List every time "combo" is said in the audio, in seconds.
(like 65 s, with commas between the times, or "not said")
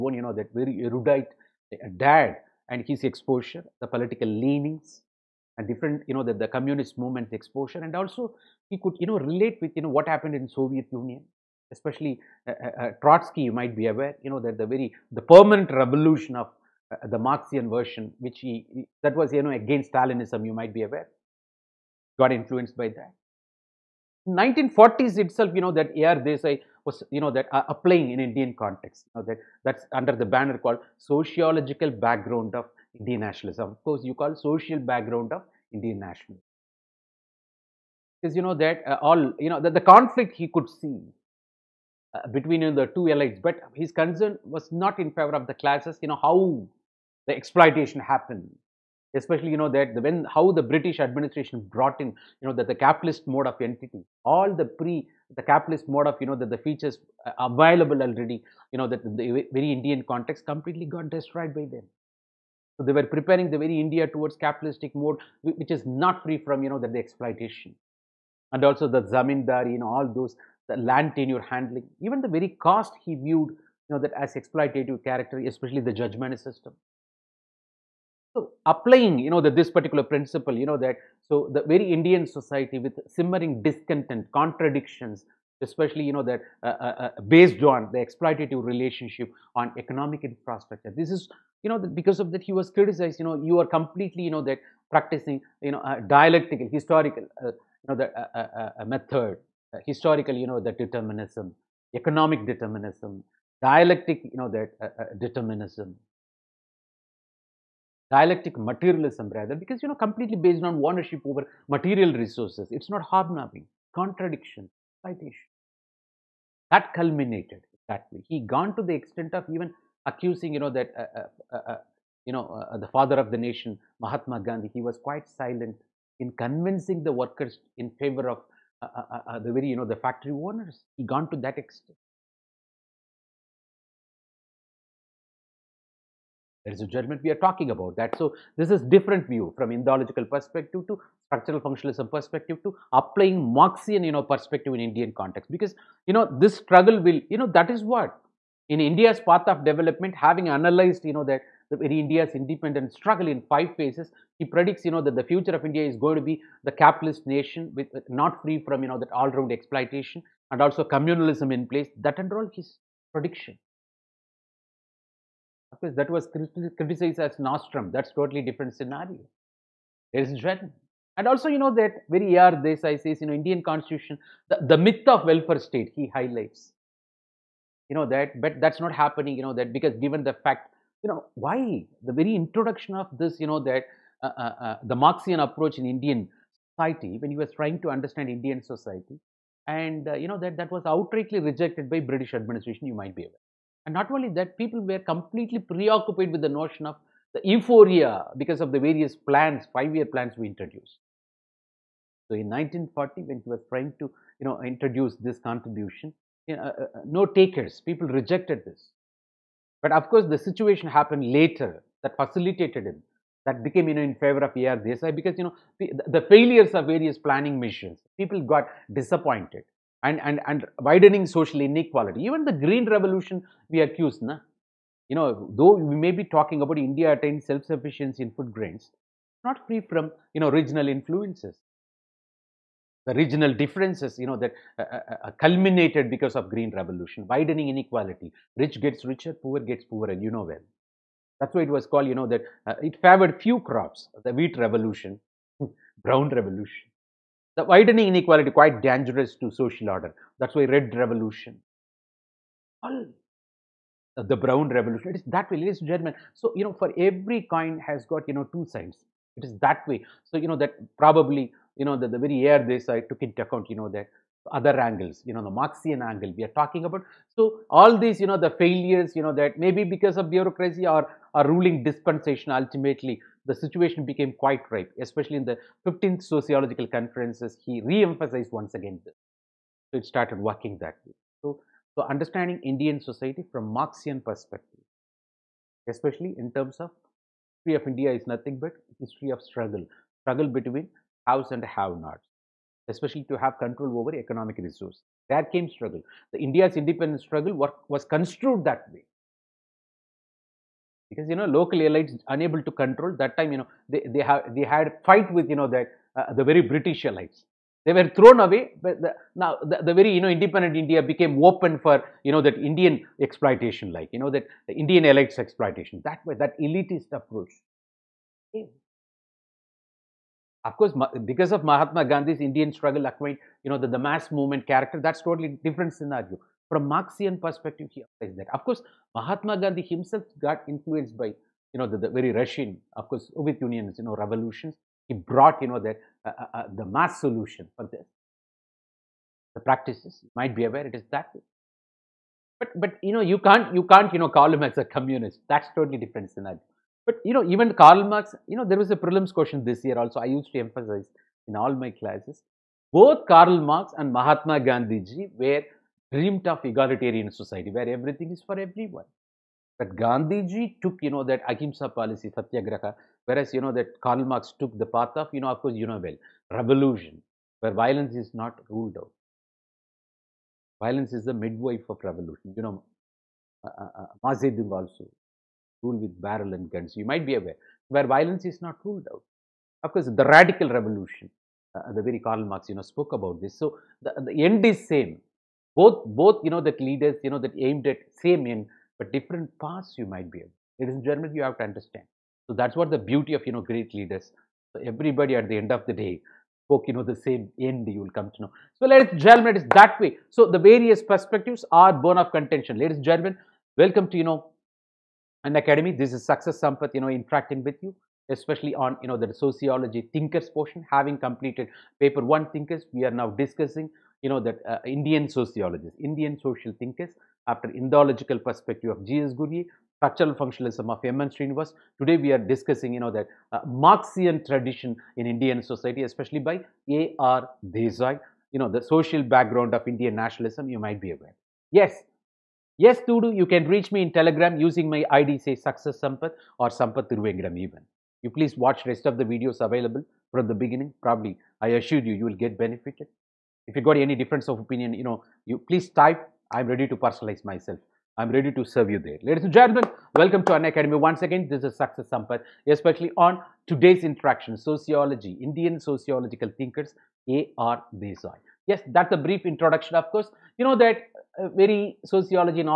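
not said.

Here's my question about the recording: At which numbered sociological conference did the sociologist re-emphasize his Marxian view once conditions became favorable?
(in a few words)
15th.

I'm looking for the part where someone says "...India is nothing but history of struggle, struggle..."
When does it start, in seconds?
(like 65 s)
287 s.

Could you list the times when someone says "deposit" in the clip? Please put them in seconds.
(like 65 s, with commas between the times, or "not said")
not said.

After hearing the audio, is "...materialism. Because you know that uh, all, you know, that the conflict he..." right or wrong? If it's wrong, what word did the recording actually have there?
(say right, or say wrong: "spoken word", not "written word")
wrong: "nationalism", not "materialism".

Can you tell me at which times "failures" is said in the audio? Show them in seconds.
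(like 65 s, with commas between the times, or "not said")
216 s, 268 s.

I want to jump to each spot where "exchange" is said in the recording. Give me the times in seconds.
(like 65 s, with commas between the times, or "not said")
not said.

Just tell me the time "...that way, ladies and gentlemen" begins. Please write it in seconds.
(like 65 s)
255 s.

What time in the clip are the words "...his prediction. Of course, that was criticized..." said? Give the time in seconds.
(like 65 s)
162 s.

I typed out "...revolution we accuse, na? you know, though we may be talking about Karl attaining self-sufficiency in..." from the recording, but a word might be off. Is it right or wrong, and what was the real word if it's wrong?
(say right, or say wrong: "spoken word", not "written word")
wrong: "India", not "Karl".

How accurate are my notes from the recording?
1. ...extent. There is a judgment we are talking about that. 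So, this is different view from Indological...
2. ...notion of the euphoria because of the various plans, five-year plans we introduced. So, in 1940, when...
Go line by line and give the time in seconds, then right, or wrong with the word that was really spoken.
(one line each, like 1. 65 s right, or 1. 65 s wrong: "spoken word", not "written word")
1. 131 s right
2. 196 s right.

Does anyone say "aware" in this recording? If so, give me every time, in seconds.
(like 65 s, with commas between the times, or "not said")
13 s, 20 s, 193 s, 340 s, 377 s, 431 s.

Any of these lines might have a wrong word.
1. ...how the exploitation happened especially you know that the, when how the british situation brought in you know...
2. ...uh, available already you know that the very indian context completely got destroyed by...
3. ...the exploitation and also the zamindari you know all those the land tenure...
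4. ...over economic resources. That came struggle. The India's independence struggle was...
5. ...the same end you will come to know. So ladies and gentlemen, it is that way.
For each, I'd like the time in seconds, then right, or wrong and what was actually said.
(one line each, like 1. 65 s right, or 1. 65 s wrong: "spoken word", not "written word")
1. 46 s wrong: "administration", not "situation"
2. 57 s right
3. 66 s right
4. 293 s right
5. 397 s right.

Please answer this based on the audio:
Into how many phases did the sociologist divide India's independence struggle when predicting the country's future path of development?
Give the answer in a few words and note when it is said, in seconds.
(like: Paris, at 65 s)
5, at 153 s.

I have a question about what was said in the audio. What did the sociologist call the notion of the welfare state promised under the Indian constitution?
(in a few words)
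the myth.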